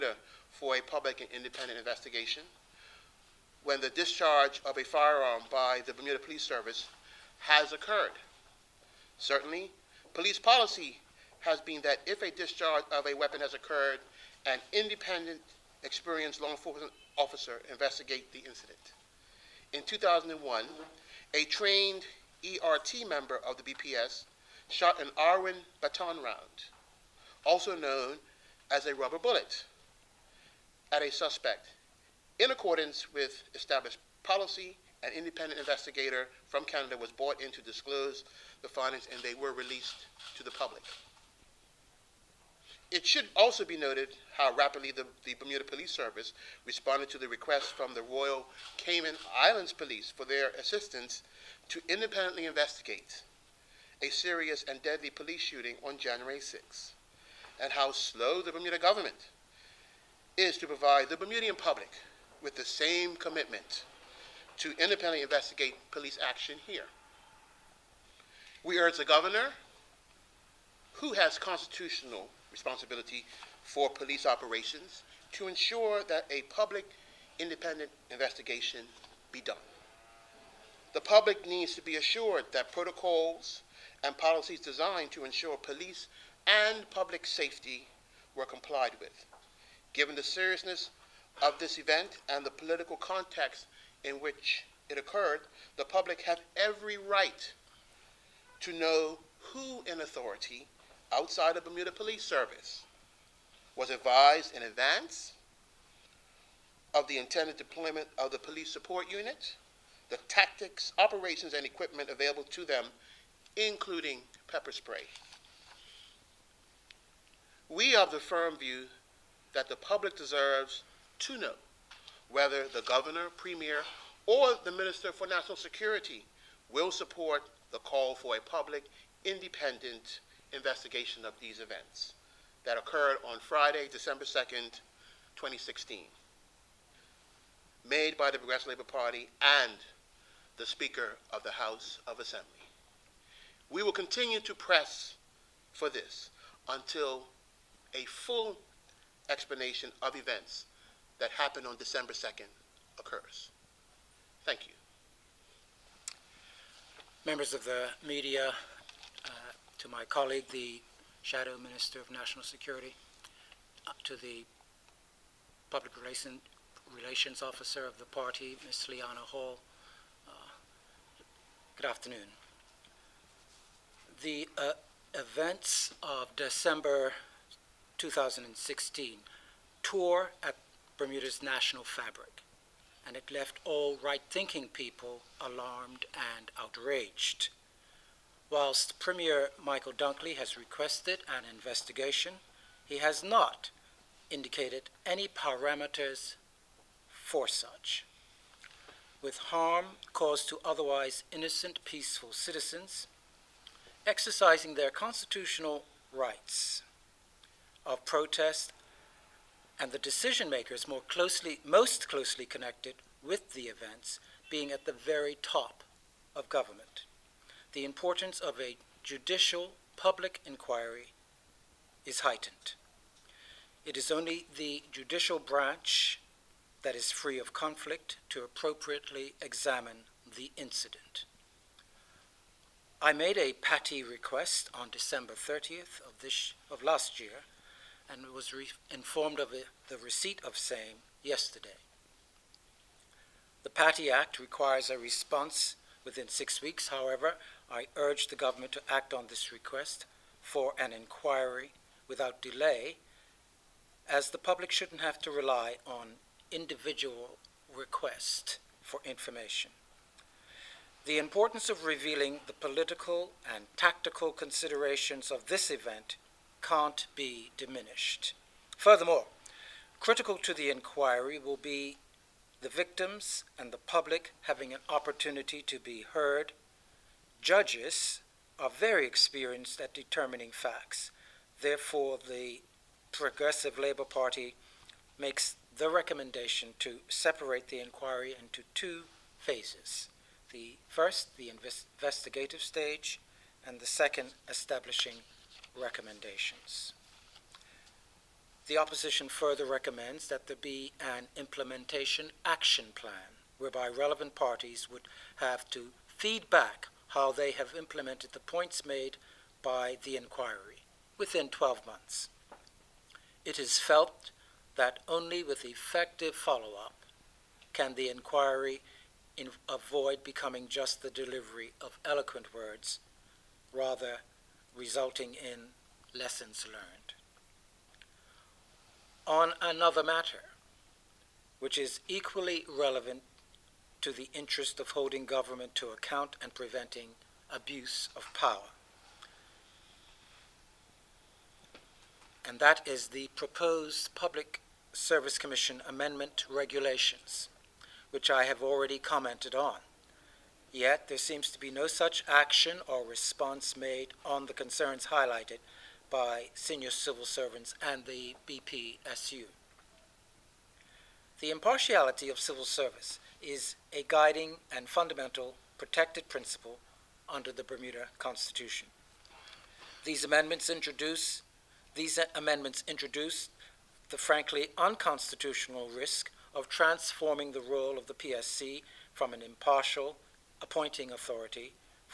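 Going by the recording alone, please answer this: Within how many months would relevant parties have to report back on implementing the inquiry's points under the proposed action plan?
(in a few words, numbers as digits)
12 months.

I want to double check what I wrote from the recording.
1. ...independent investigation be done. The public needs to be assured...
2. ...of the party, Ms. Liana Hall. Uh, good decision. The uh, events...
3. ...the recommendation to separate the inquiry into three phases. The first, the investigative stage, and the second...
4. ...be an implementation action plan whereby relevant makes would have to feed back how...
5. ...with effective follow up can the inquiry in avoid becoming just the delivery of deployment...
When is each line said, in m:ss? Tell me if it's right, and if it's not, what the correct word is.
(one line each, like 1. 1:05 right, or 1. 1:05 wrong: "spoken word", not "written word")
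1. 1:17 right
2. 2:47 wrong: "afternoon", not "decision"
3. 4:45 wrong: "two", not "three"
4. 5:00 wrong: "parties", not "makes"
5. 5:15 wrong: "eloquent", not "deployment".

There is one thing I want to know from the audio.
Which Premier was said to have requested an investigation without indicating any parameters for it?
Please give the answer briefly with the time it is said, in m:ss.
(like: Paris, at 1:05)
Michael Dunkley, at 3:09.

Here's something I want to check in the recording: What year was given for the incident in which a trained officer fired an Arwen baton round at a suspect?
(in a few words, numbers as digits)
2001.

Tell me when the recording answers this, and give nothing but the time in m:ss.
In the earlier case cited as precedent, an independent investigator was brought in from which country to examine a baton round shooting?
0:36.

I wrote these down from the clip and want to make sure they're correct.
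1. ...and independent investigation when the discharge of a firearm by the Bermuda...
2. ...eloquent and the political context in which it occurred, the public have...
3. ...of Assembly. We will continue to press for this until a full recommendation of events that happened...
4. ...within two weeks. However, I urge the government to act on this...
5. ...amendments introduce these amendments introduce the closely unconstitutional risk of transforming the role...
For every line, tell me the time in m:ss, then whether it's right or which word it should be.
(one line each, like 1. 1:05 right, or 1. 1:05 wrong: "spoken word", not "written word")
1. 0:01 right
2. 1:31 wrong: "event", not "eloquent"
3. 2:22 wrong: "explanation", not "recommendation"
4. 4:06 wrong: "six", not "two"
5. 6:10 wrong: "frankly", not "closely".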